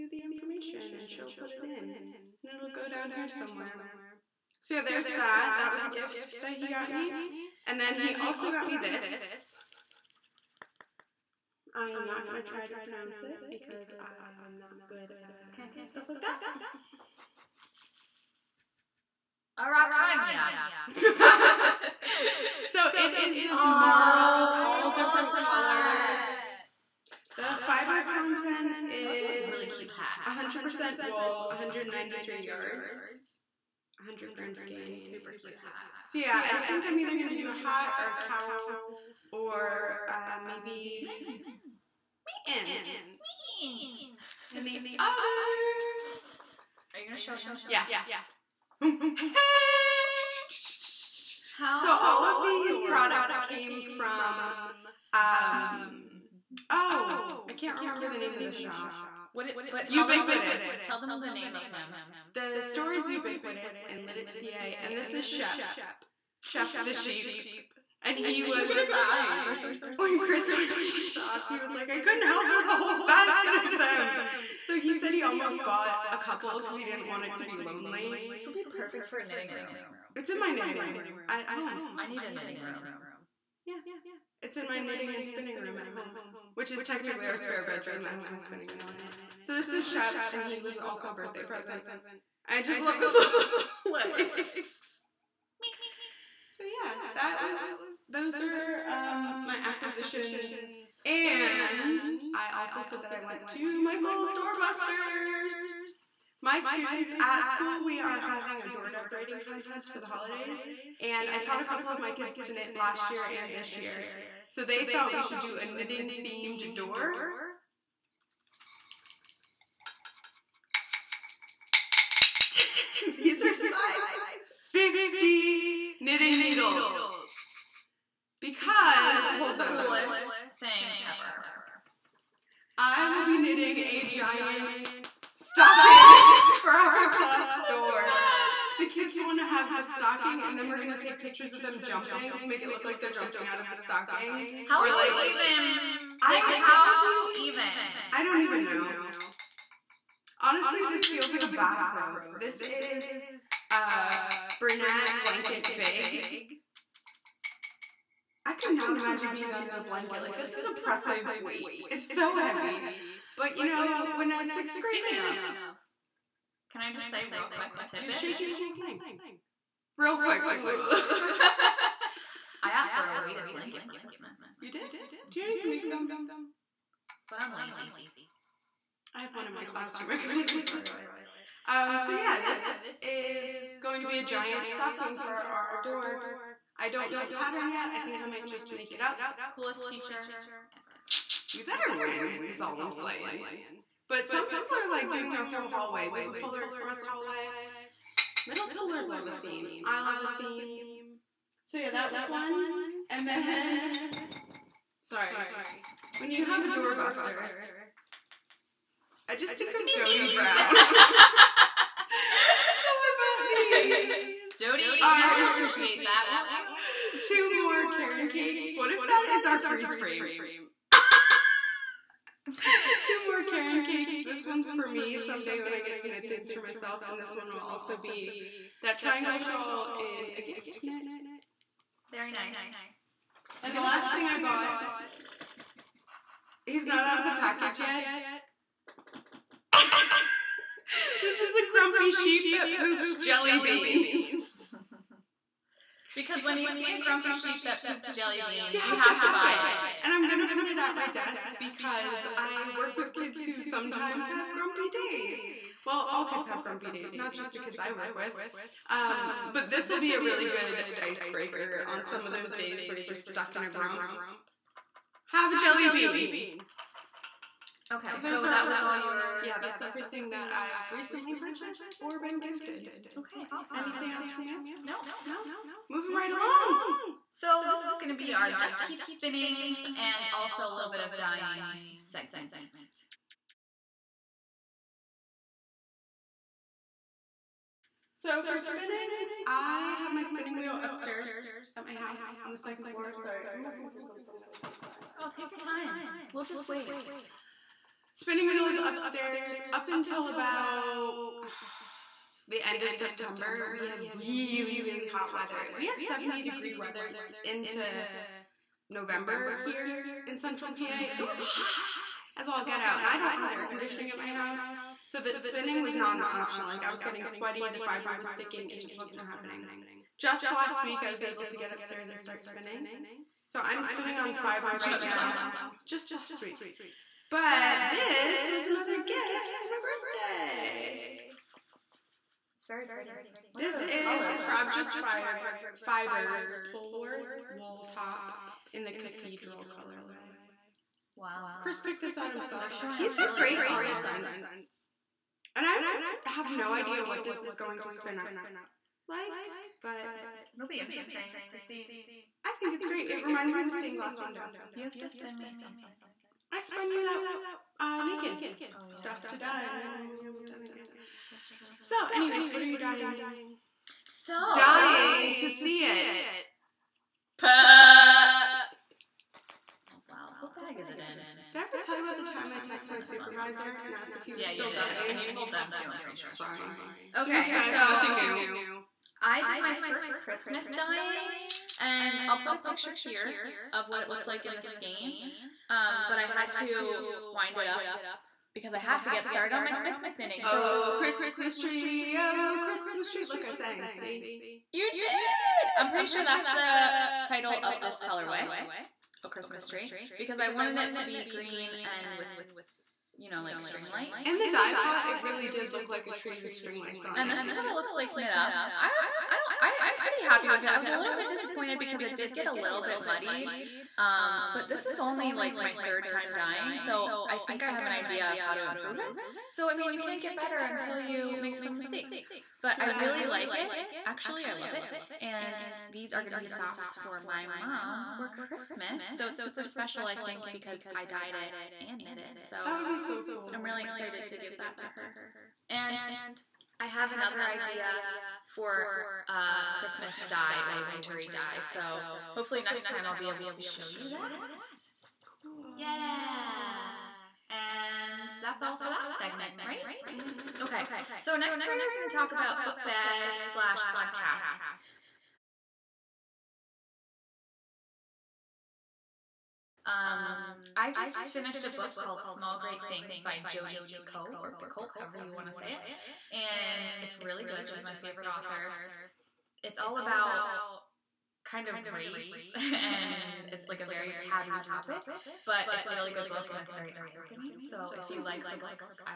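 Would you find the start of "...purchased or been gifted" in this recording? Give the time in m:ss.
4:31.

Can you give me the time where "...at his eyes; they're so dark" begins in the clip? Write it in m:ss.
1:08.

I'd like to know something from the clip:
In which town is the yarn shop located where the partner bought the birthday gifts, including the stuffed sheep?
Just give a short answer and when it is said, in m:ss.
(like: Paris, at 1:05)
Lititz, PA, at 1:03.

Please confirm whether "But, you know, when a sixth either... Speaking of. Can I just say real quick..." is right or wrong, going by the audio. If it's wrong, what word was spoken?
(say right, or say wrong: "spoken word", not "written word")
wrong: "grader", not "either".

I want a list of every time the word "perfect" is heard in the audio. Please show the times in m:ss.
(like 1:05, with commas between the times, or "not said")
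1:18.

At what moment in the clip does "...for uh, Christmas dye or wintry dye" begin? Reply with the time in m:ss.
7:18.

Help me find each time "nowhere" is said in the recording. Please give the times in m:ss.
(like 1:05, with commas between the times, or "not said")
not said.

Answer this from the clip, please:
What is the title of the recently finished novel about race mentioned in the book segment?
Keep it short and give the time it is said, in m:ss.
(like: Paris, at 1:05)
Small Great Things, at 7:42.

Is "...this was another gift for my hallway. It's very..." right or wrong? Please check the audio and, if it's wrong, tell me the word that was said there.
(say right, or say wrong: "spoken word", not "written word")
wrong: "birthday", not "hallway".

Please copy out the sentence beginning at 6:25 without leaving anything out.
Um, but I had to wind it up because I have to get started on my Christmas knitting.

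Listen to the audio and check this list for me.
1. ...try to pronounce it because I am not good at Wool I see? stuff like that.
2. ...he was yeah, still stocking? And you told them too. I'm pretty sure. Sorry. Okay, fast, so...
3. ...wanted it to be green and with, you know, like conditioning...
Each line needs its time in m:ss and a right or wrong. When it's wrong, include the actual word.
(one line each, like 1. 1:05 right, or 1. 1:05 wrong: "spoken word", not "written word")
1. 0:12 wrong: "Can", not "Wool"
2. 6:14 wrong: "dying", not "stocking"
3. 6:40 wrong: "string", not "conditioning".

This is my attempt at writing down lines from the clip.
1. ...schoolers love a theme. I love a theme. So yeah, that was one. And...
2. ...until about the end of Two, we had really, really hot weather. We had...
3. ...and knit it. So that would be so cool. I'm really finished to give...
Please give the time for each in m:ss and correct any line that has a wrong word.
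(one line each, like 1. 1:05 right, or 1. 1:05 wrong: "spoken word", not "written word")
1. 3:18 right
2. 4:59 wrong: "September", not "Two"
3. 7:11 wrong: "excited", not "finished".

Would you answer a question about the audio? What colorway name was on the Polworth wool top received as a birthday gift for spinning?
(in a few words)
Cathedral.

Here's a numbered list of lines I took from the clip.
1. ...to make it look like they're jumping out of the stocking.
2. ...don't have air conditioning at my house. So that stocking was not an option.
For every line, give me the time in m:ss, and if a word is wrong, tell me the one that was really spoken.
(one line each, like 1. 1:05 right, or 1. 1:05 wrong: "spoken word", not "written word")
1. 2:22 right
2. 5:13 wrong: "spinning", not "stocking".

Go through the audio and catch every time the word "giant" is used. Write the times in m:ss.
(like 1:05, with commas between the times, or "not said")
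2:14, 3:04.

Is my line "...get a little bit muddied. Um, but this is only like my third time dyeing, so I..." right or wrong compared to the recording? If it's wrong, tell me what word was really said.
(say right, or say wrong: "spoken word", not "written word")
right.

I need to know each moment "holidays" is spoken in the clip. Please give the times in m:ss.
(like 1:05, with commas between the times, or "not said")
1:50.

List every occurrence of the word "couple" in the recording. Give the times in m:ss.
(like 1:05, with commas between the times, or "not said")
1:16, 1:51.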